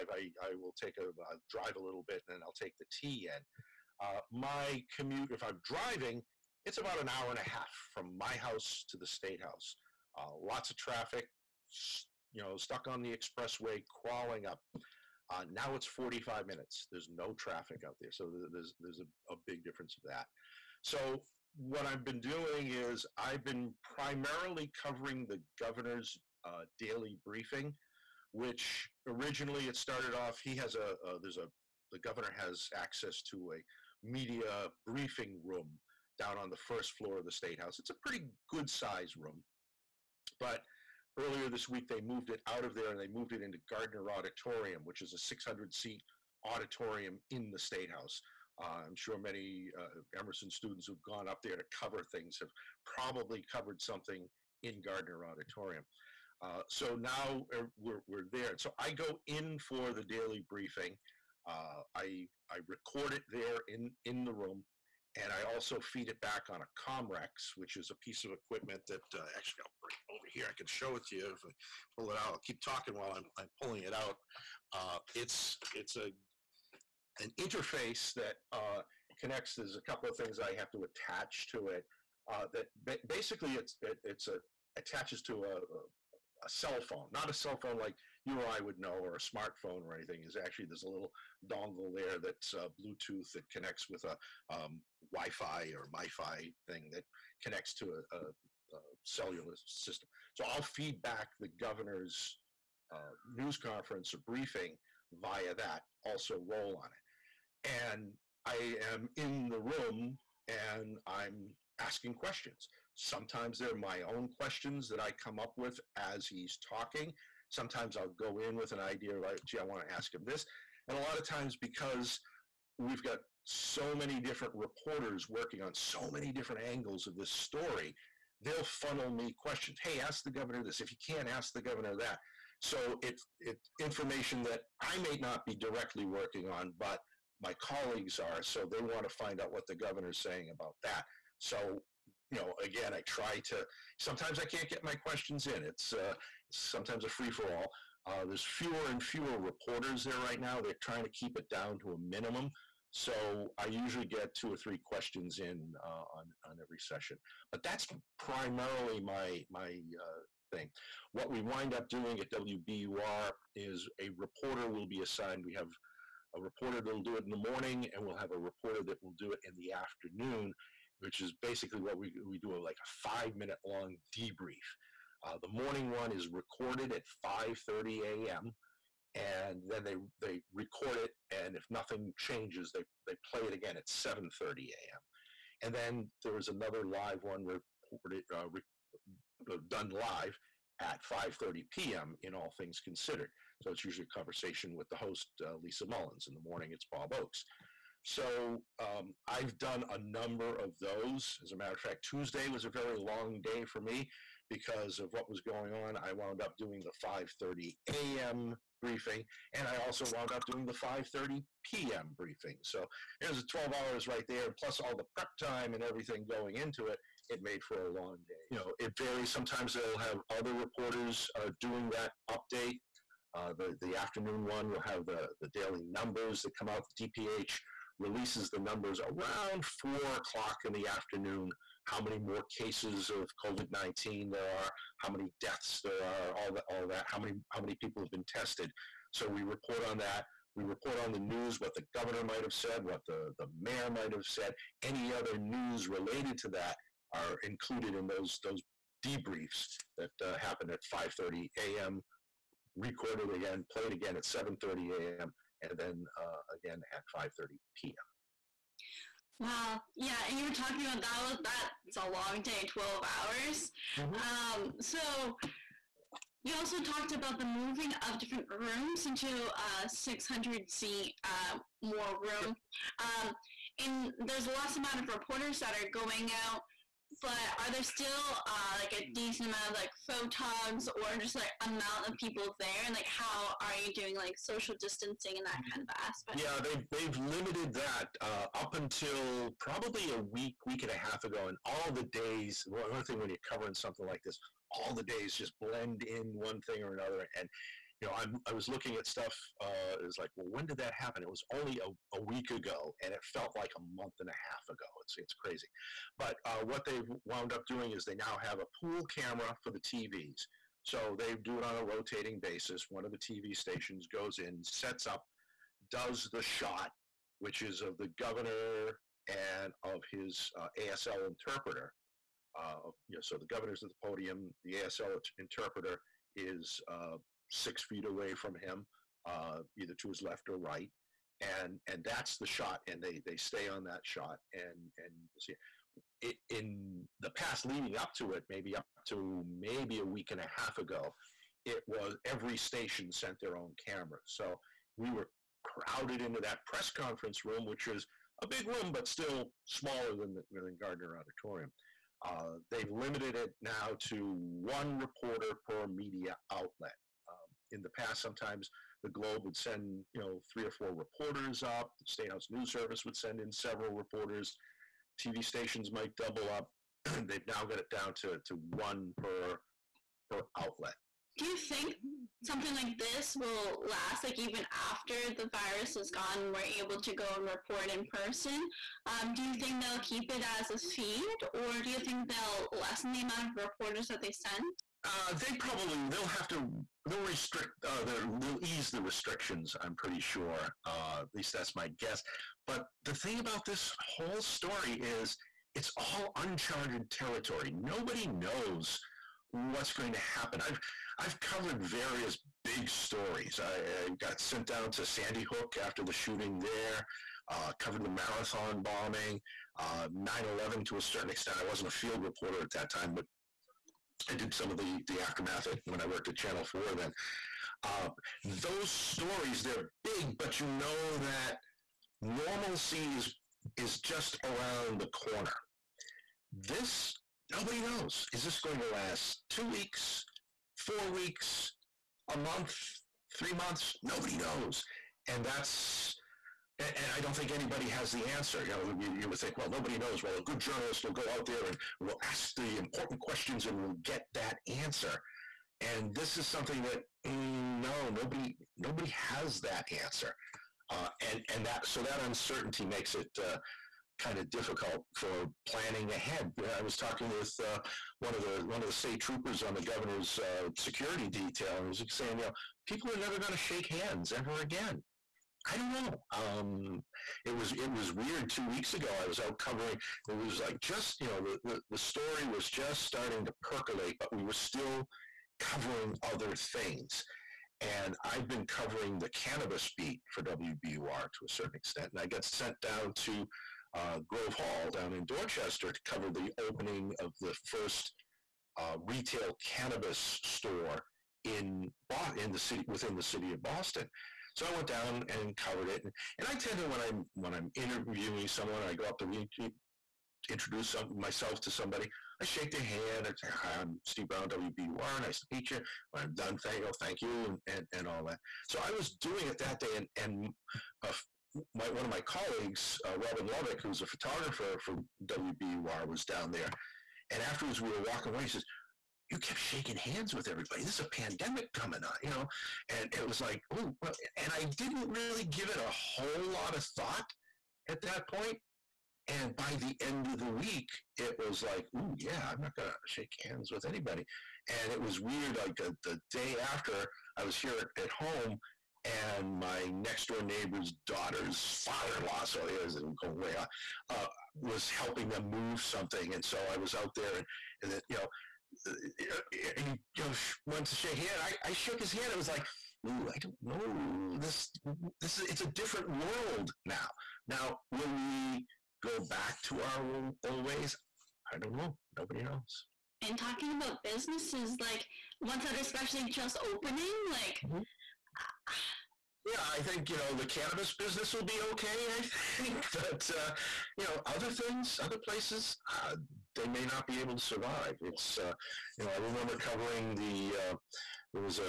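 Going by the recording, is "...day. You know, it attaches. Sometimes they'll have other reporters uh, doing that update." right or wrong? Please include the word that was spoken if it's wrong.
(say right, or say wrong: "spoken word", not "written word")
wrong: "varies", not "attaches".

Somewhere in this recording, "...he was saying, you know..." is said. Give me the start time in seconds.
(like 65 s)
461 s.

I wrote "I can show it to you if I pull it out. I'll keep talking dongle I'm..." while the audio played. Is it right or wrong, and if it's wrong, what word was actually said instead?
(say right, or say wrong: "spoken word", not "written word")
wrong: "while", not "dongle".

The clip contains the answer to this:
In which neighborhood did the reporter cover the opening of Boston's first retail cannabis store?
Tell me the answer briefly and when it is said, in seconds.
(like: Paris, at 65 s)
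Grove Hall, at 484 s.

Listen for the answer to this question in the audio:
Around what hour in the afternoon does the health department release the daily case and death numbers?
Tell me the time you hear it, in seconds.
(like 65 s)
229 s.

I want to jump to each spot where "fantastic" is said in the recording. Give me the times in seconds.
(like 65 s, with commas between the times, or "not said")
not said.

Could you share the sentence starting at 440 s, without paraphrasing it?
Well, a good journalist will go out there and will ask the important questions and will get that answer.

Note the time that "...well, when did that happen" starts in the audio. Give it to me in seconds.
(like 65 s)
300 s.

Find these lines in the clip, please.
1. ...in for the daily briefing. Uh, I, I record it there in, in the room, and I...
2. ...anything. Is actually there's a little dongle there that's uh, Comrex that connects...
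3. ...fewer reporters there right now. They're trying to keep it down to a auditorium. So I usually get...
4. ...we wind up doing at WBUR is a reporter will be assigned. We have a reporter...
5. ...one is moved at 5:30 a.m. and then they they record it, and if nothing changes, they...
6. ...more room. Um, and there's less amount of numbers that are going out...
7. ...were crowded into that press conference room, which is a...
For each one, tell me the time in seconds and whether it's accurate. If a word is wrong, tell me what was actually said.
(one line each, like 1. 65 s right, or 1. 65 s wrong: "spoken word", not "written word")
1. 59 s right
2. 89 s wrong: "Bluetooth", not "Comrex"
3. 149 s wrong: "minimum", not "auditorium"
4. 161 s right
5. 175 s wrong: "recorded", not "moved"
6. 271 s wrong: "reporters", not "numbers"
7. 345 s right.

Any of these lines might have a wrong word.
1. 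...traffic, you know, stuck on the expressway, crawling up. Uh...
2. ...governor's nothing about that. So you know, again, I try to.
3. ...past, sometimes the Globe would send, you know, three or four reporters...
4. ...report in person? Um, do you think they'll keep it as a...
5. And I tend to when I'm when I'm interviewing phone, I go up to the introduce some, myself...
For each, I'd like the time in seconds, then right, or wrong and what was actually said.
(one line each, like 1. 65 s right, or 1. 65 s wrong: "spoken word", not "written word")
1. 10 s right
2. 139 s wrong: "saying", not "nothing"
3. 357 s right
4. 377 s right
5. 496 s wrong: "someone", not "phone".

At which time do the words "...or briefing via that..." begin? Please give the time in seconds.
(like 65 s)
104 s.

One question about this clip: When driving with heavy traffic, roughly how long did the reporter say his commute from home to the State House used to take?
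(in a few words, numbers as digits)
an hour and a half.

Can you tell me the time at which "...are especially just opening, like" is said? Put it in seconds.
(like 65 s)
565 s.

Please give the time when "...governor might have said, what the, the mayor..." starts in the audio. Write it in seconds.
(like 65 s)
241 s.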